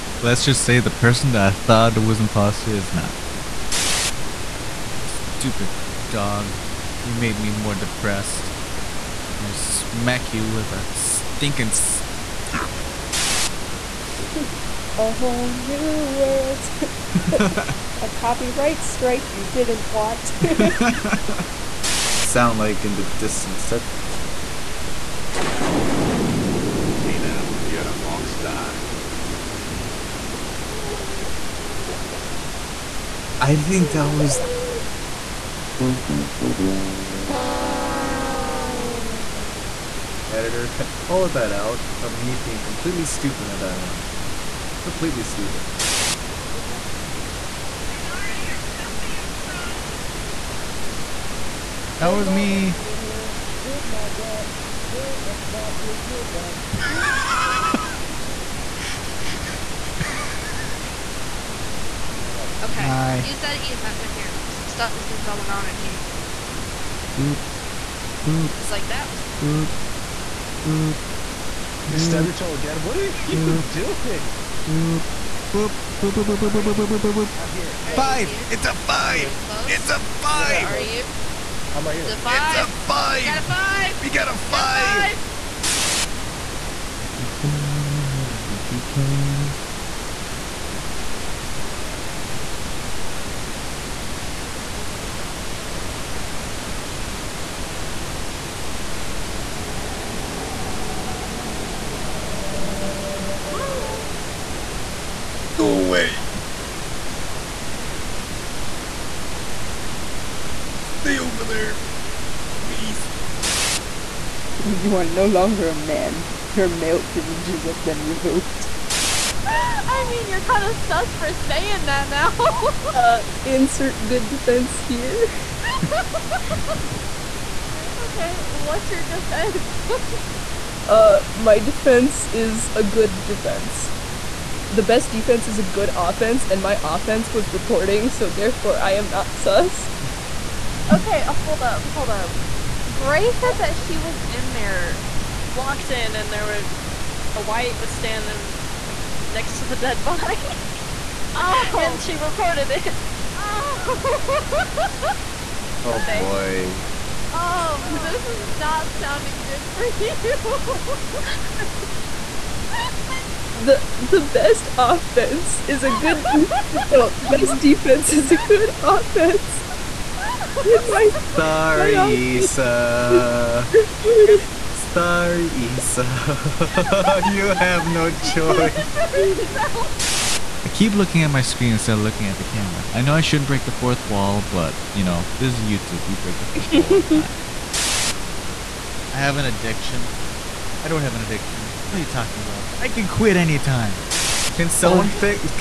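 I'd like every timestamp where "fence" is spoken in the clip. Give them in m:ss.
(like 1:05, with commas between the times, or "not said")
not said.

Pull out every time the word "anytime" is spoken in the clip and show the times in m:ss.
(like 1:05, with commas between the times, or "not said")
3:13.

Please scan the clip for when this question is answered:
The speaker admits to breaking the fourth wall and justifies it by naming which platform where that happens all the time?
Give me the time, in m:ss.
3:05.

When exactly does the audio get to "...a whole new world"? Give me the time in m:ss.
0:14.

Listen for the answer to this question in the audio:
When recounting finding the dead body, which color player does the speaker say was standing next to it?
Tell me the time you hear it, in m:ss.
2:27.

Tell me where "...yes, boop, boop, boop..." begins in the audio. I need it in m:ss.
1:15.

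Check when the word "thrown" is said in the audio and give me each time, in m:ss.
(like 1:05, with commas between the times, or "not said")
0:49, 1:09.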